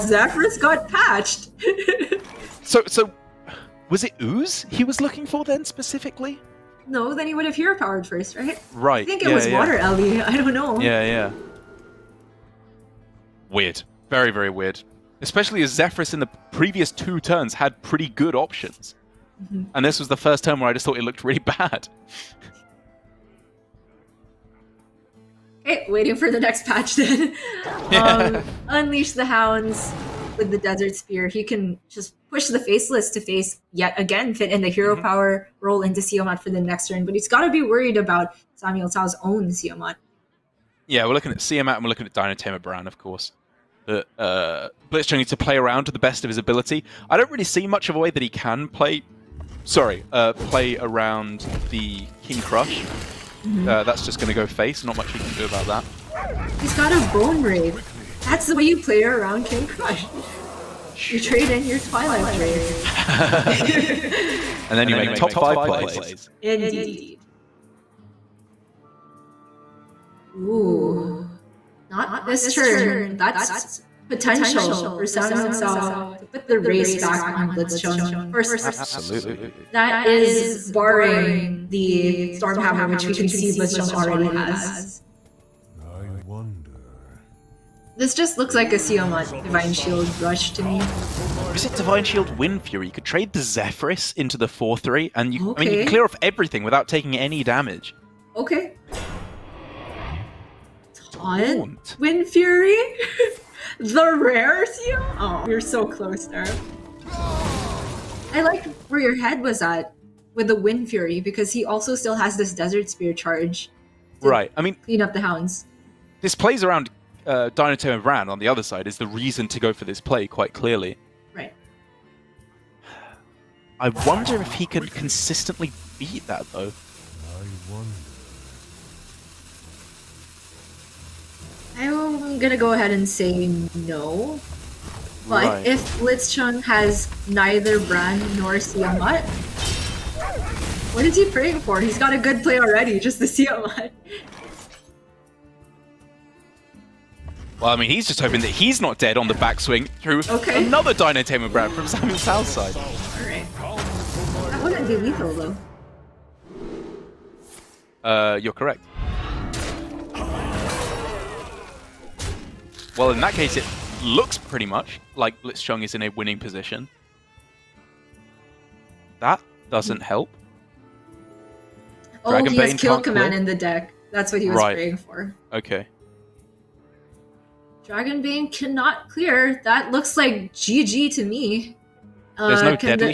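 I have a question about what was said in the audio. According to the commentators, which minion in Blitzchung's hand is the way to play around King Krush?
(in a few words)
Bone Wraith.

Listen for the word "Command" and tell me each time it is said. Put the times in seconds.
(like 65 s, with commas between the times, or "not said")
172 s.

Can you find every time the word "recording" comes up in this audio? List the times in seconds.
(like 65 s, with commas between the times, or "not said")
not said.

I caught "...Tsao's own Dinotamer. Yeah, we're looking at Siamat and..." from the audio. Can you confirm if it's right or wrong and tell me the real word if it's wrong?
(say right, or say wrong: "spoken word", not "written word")
wrong: "Siamat", not "Dinotamer".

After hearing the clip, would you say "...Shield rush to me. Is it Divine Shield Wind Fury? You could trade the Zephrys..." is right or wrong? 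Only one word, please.
right.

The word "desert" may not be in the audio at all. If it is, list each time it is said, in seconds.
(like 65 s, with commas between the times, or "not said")
30 s, 112 s.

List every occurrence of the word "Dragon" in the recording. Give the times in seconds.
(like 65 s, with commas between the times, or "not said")
172 s, 177 s.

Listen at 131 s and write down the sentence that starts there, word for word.
I'm gonna go ahead and say no.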